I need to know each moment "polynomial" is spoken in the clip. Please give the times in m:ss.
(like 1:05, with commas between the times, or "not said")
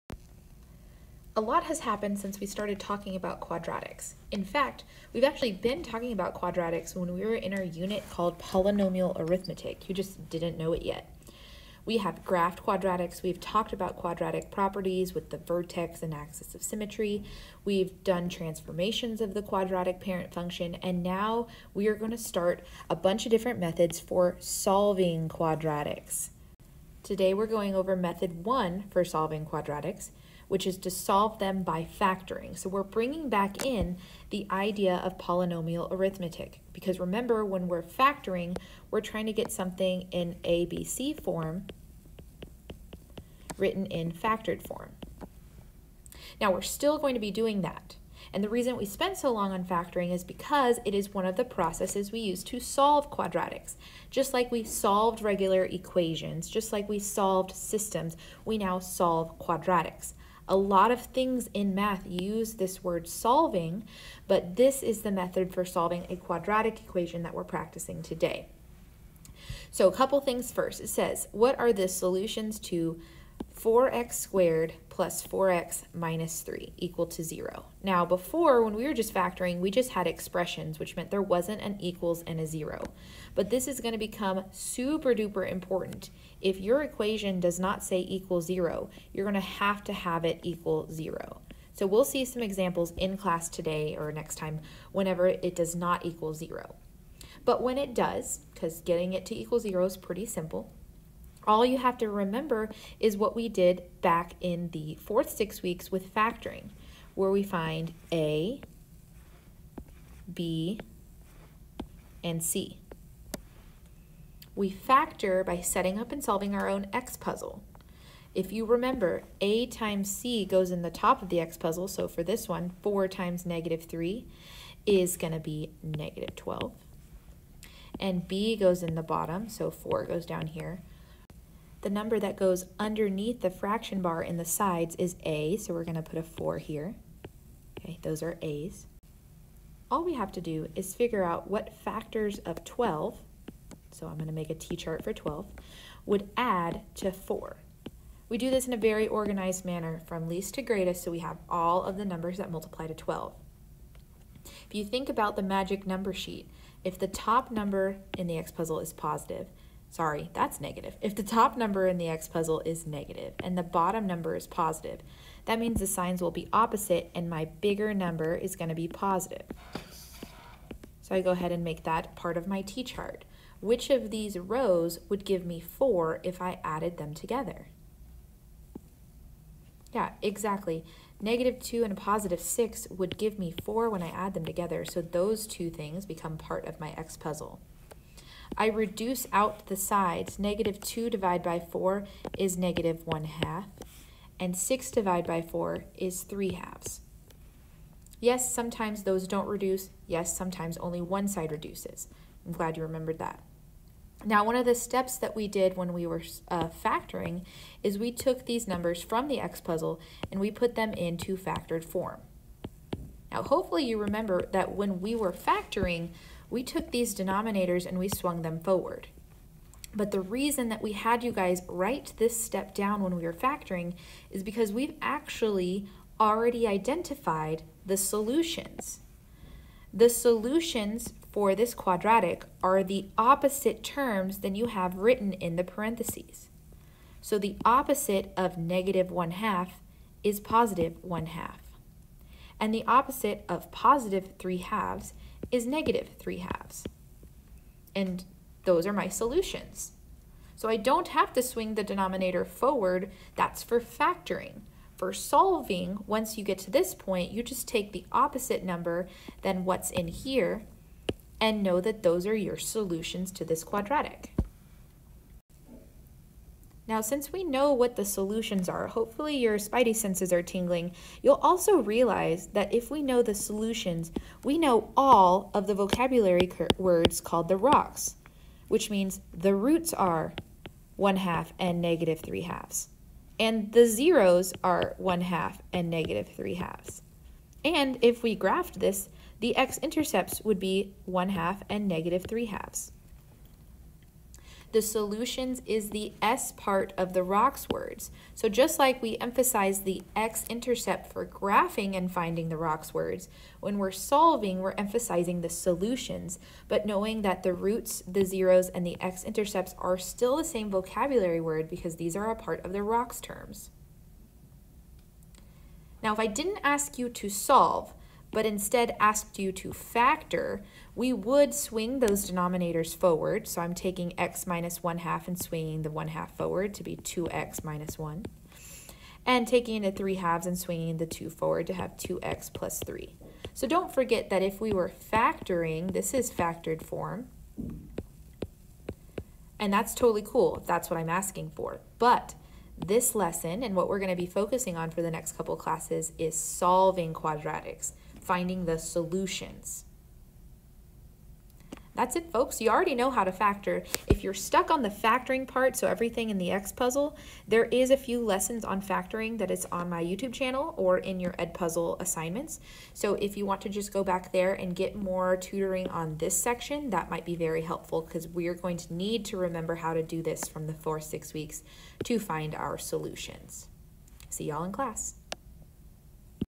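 0:08, 0:35.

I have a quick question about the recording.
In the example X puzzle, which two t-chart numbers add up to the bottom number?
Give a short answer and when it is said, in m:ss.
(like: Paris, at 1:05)
-2 and 6, at 3:01.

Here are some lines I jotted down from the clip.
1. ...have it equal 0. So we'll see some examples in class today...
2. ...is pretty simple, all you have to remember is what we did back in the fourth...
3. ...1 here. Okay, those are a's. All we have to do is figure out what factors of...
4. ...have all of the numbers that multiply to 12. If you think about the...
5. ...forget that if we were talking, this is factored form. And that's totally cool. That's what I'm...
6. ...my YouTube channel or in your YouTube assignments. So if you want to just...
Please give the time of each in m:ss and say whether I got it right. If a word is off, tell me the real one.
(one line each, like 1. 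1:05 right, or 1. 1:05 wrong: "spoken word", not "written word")
1. 1:29 right
2. 1:39 right
3. 2:16 wrong: "4", not "1"
4. 2:31 right
5. 5:33 wrong: "factoring", not "talking"
6. 5:59 wrong: "Edpuzzle", not "YouTube".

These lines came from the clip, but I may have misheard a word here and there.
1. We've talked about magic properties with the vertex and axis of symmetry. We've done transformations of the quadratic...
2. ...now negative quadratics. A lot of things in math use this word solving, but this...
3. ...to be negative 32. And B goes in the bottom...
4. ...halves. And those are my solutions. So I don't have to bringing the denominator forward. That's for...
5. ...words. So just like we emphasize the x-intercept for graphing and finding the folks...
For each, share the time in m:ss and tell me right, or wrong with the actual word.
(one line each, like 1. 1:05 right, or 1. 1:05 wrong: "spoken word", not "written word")
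1. 0:13 wrong: "quadratic", not "magic"
2. 0:58 wrong: "solve", not "negative"
3. 2:05 wrong: "12", not "32"
4. 4:06 wrong: "swing", not "bringing"
5. 4:57 wrong: "rocks", not "folks".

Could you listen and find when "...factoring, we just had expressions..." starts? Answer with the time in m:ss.
1:19.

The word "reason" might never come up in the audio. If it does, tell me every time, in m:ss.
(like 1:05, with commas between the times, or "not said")
0:48, 3:40.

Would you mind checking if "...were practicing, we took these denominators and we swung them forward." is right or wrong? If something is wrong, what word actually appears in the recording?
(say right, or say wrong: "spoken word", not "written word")
wrong: "factoring", not "practicing".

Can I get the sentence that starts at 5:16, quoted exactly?
Now, if I didn't ask you to solve, but instead asked you to factor, we would swing those denominators forward.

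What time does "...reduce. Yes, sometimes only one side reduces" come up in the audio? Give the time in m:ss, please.
3:19.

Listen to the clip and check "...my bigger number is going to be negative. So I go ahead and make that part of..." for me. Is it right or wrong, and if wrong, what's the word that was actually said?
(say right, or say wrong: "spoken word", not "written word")
wrong: "positive", not "negative".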